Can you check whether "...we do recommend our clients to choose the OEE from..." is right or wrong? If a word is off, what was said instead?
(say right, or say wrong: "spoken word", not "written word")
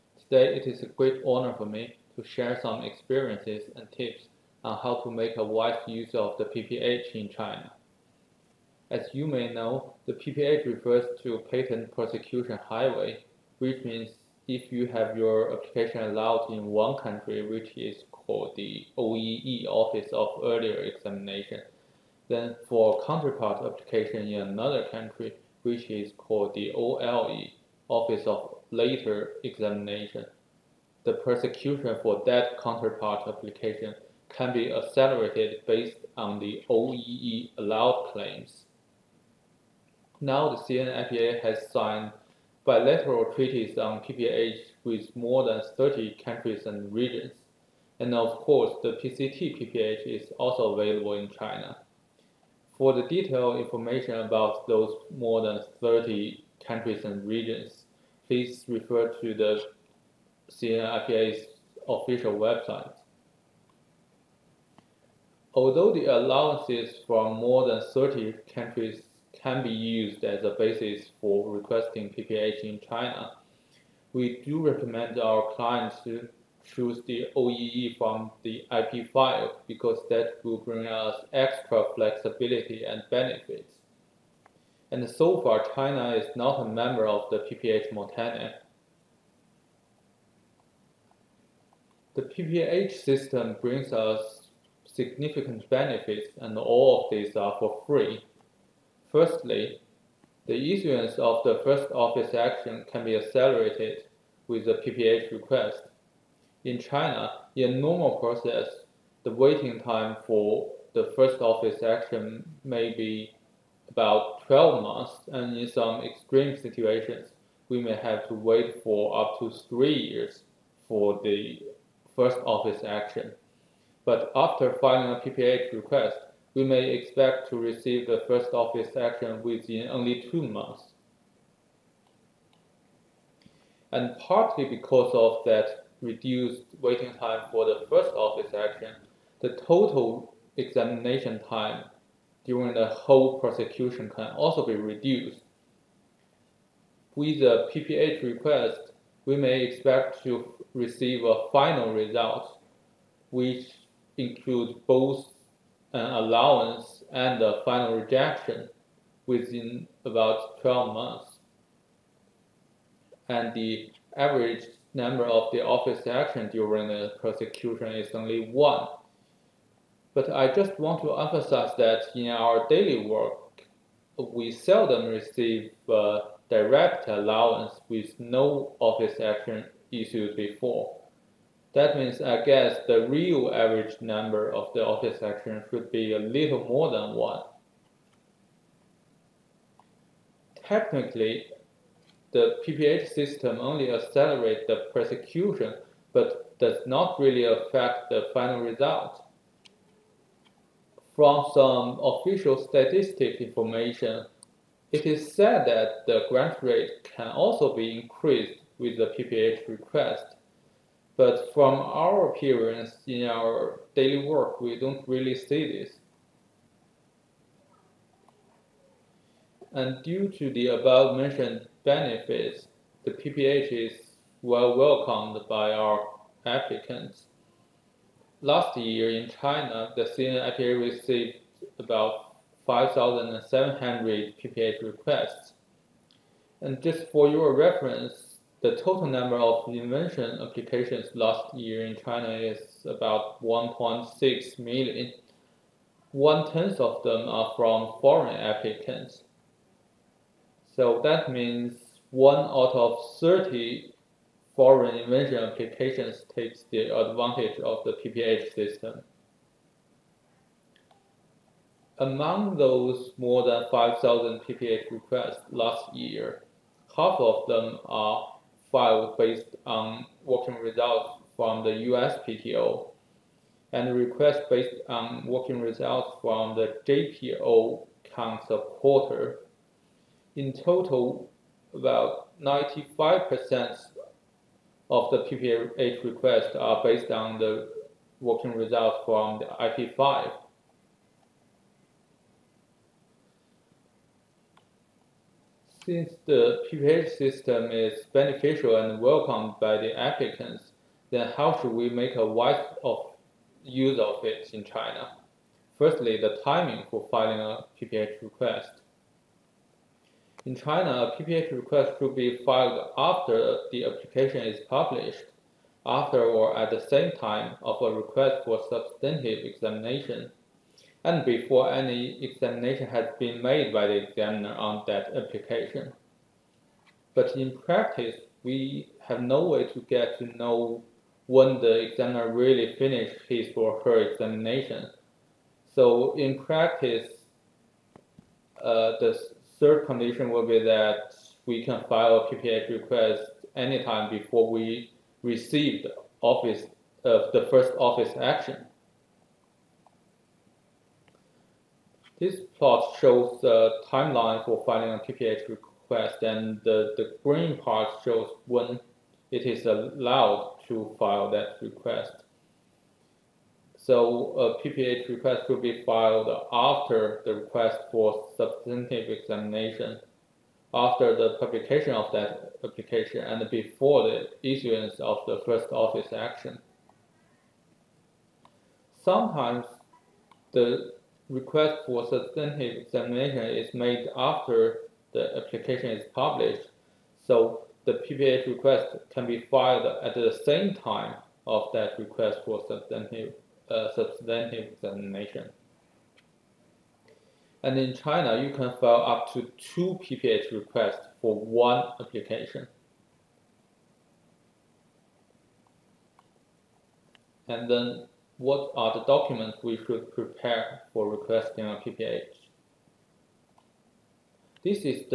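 right.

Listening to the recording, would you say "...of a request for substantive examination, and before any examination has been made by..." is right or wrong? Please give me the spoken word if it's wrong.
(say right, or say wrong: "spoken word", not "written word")
right.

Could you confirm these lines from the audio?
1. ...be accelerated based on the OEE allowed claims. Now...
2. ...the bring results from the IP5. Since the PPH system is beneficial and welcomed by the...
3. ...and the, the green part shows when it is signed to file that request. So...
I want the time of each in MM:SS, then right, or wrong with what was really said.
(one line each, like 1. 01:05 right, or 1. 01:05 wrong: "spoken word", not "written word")
1. 00:34 right
2. 04:47 wrong: "working", not "bring"
3. 05:56 wrong: "allowed", not "signed".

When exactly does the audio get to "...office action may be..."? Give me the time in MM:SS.
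01:51.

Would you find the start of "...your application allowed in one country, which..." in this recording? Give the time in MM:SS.
00:15.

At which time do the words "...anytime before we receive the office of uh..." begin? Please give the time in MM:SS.
05:43.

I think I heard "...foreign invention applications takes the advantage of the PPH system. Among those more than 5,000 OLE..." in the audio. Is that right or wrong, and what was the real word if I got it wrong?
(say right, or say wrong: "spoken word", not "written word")
wrong: "PPH", not "OLE".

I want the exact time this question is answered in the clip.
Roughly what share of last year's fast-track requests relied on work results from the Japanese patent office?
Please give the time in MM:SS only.
04:38.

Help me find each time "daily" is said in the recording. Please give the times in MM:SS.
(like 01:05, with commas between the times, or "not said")
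02:52, 03:33.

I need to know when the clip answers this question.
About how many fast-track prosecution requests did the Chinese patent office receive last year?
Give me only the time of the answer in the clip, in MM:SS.
03:51.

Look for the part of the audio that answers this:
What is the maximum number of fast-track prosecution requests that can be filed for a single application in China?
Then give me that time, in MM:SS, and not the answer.
06:39.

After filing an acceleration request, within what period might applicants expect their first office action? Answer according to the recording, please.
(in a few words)
2 months.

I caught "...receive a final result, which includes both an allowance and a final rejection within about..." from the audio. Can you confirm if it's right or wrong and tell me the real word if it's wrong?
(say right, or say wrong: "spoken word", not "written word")
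right.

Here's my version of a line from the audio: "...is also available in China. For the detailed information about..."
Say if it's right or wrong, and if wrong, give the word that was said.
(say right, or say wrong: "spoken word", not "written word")
right.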